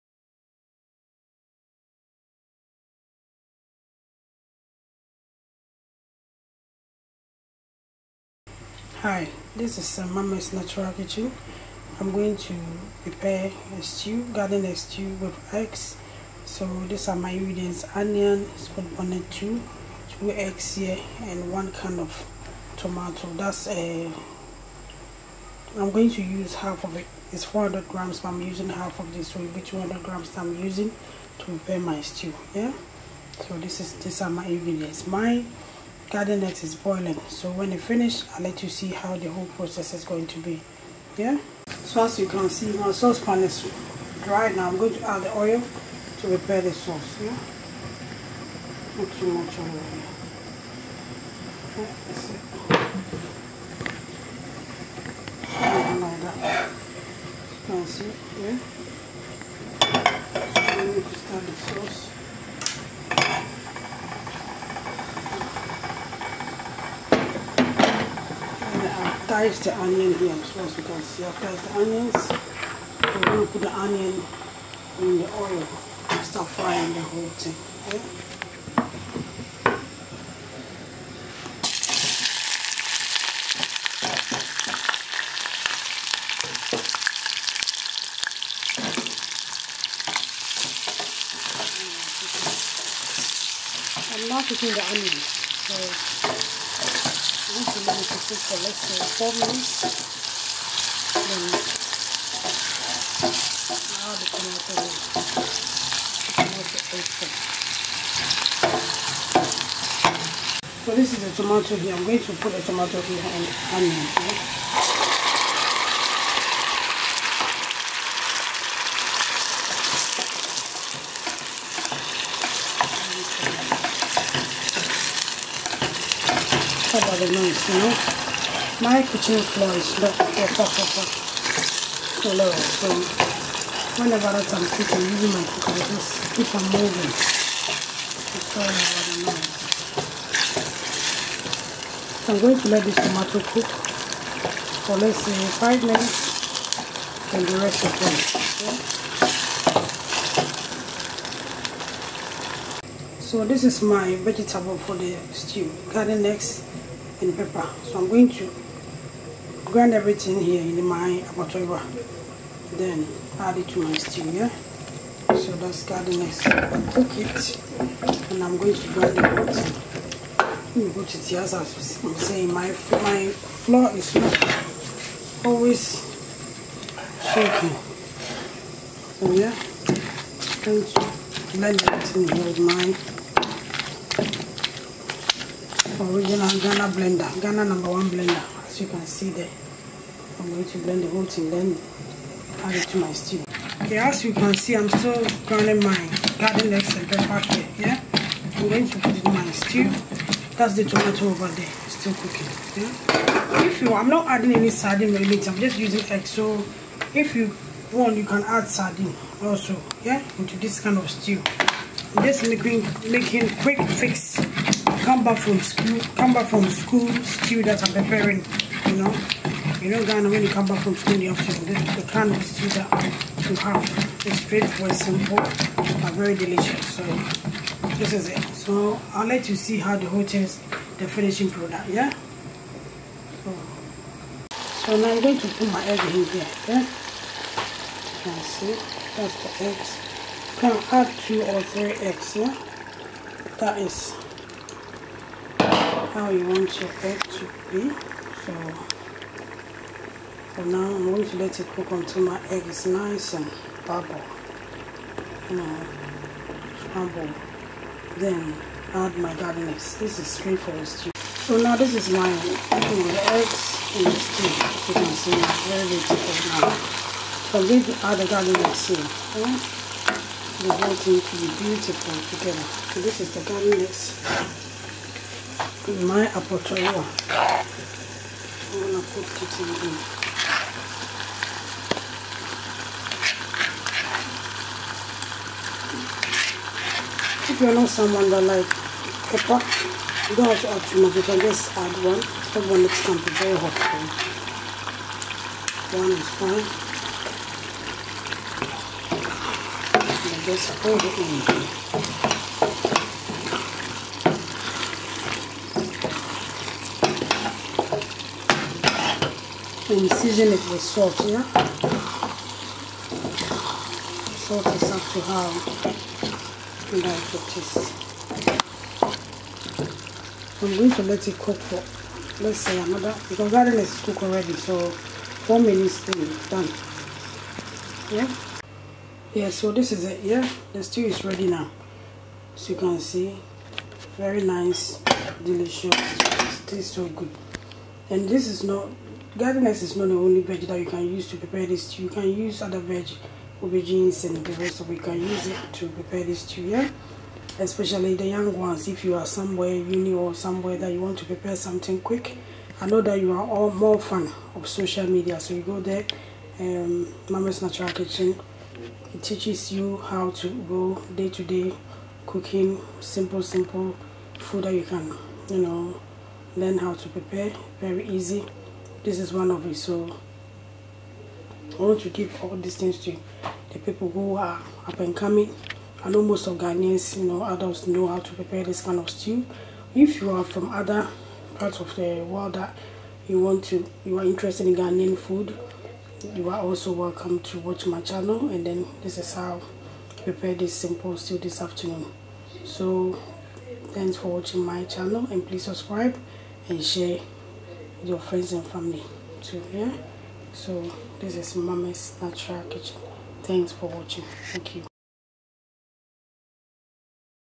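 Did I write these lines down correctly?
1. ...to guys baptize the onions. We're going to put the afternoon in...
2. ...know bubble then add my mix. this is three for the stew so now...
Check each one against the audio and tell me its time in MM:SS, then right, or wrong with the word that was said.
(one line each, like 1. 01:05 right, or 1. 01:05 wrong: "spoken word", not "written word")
1. 01:10 wrong: "onion", not "afternoon"
2. 04:15 right.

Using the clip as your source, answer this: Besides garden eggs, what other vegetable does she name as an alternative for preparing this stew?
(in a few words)
aubergines.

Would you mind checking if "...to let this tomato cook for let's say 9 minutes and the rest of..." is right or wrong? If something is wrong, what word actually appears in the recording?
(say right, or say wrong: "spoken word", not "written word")
wrong: "5", not "9".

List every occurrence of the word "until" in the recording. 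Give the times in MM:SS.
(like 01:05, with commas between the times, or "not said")
04:11.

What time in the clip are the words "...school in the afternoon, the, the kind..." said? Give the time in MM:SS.
03:40.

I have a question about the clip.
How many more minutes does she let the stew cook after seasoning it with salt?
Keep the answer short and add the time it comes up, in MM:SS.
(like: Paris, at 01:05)
4 minutes, at 05:25.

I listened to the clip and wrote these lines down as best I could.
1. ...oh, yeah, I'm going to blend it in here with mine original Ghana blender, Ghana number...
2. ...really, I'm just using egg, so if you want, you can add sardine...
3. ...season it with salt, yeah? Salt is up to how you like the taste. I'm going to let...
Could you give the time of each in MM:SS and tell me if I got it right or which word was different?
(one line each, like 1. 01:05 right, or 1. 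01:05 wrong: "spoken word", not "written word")
1. 02:59 right
2. 03:25 right
3. 05:10 right.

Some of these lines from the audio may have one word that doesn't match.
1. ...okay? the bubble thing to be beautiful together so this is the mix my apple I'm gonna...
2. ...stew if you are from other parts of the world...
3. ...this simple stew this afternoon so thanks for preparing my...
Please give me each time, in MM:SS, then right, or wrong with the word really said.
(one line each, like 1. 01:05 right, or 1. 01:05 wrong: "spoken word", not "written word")
1. 04:29 wrong: "whole", not "bubble"
2. 06:19 right
3. 06:30 wrong: "watching", not "preparing".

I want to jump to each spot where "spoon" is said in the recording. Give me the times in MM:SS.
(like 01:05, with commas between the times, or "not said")
00:18.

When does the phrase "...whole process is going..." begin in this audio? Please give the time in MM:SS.
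00:39.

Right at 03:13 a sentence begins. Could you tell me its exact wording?
Okay, as you can see, I'm still grinding my garden eggs and pepper here, yeah?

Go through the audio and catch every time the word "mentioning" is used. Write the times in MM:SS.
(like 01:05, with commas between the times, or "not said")
not said.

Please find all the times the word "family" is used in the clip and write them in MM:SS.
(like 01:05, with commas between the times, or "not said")
06:38.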